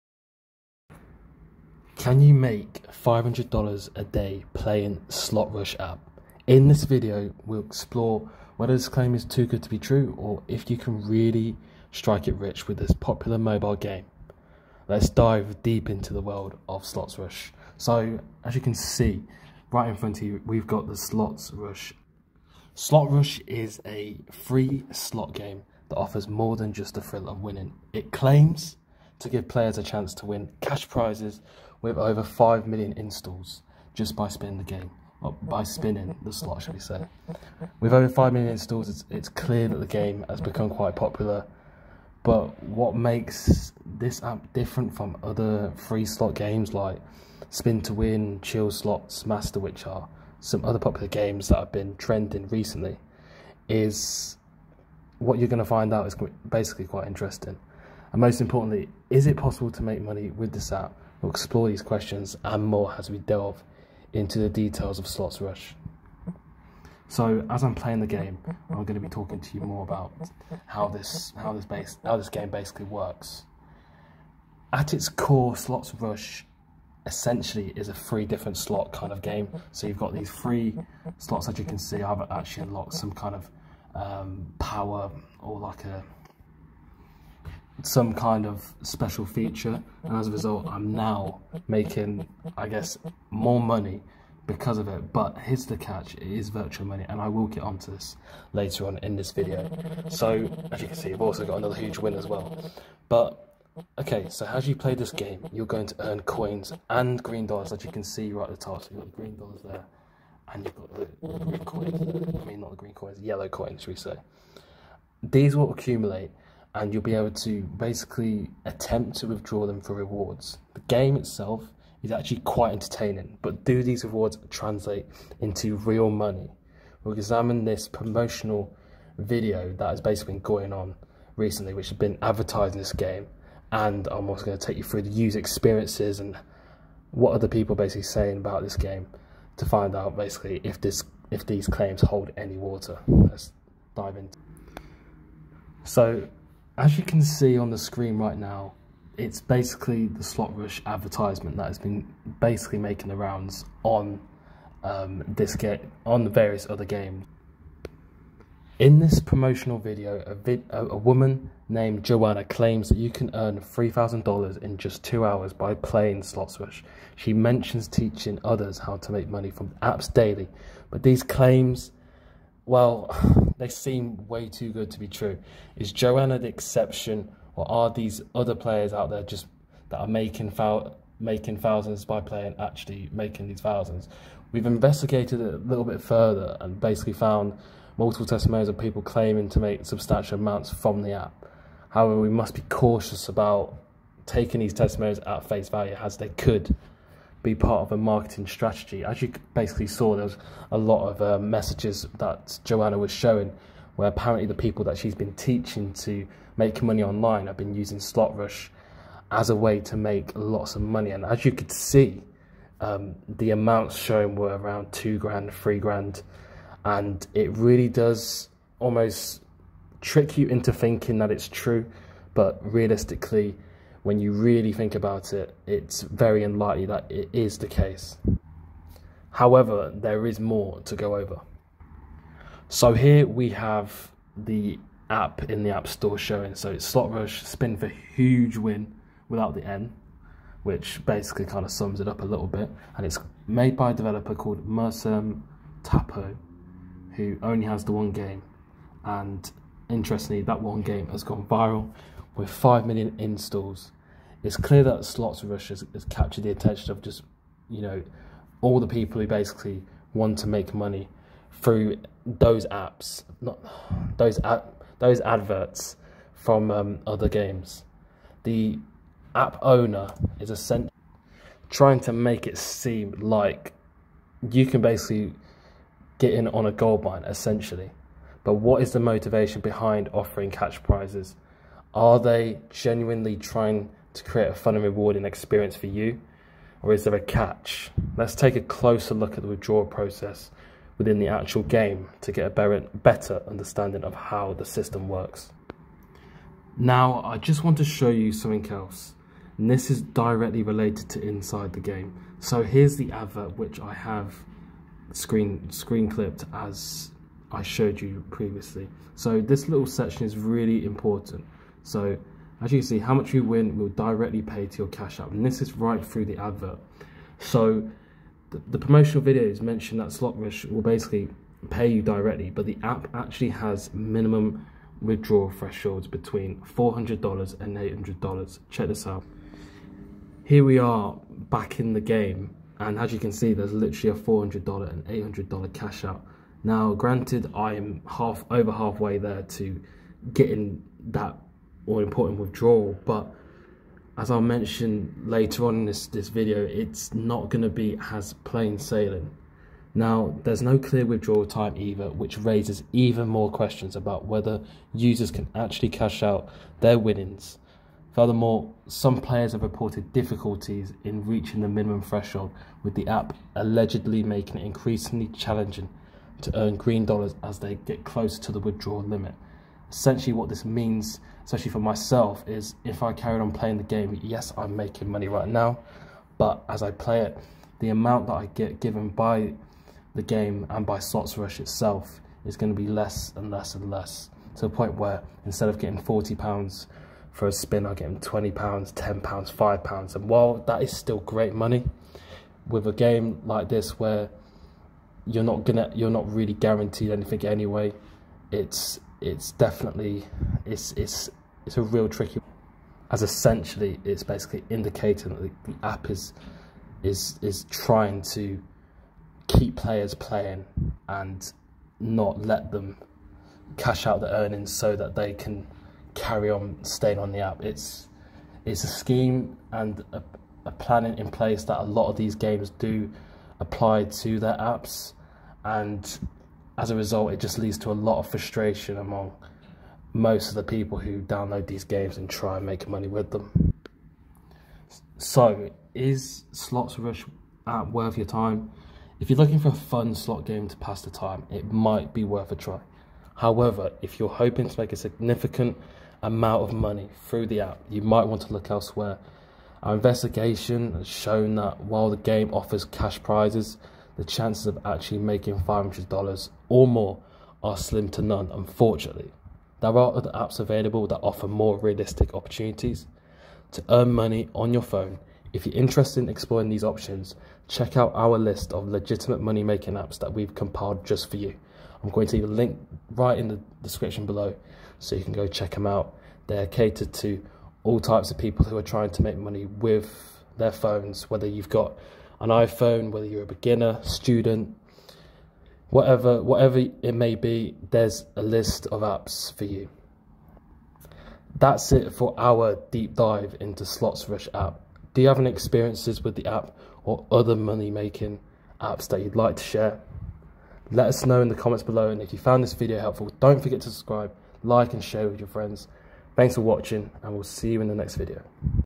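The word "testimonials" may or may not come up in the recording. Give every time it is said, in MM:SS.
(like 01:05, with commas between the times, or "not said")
03:08, 03:14.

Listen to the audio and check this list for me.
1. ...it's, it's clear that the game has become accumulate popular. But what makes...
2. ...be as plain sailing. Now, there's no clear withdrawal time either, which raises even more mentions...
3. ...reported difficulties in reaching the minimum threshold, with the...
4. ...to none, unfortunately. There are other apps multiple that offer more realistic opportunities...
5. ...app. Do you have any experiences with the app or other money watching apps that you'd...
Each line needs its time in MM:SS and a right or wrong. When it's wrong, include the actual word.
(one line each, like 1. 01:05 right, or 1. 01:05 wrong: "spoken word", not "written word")
1. 00:38 wrong: "quite", not "accumulate"
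2. 05:47 wrong: "questions", not "mentions"
3. 05:59 right
4. 07:38 wrong: "available", not "multiple"
5. 08:14 wrong: "making", not "watching".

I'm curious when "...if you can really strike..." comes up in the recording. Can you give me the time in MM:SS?
00:10.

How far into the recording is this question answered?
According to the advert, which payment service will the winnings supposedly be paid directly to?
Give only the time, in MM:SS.
05:14.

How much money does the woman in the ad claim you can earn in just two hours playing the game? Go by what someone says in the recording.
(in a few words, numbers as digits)
$3,000.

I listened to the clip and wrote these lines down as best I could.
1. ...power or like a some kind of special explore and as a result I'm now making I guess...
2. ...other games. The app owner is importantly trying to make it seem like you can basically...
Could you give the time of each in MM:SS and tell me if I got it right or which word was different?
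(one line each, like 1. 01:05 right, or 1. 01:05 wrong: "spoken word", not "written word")
1. 01:24 wrong: "feature", not "explore"
2. 04:27 wrong: "essentially", not "importantly".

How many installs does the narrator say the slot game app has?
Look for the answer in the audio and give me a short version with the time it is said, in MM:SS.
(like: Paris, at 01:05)
5 million, at 00:32.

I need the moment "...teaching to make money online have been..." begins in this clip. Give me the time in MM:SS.
03:25.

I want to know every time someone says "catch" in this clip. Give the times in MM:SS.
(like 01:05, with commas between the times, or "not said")
01:35, 04:40, 04:47.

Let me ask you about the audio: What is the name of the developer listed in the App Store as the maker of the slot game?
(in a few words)
Mersum Tapo.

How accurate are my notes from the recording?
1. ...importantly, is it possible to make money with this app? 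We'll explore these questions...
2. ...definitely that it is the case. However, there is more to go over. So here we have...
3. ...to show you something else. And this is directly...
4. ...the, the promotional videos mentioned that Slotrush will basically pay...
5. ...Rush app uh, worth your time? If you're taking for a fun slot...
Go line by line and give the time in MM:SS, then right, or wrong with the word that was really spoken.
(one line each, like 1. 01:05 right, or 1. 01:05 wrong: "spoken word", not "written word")
1. 00:58 right
2. 03:46 wrong: "unlikely", not "definitely"
3. 04:57 right
4. 05:18 right
5. 07:16 wrong: "looking", not "taking".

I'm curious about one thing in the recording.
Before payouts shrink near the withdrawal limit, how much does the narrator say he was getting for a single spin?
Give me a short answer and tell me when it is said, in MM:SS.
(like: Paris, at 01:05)
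£40, at 06:26.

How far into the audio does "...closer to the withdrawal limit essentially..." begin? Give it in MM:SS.
06:08.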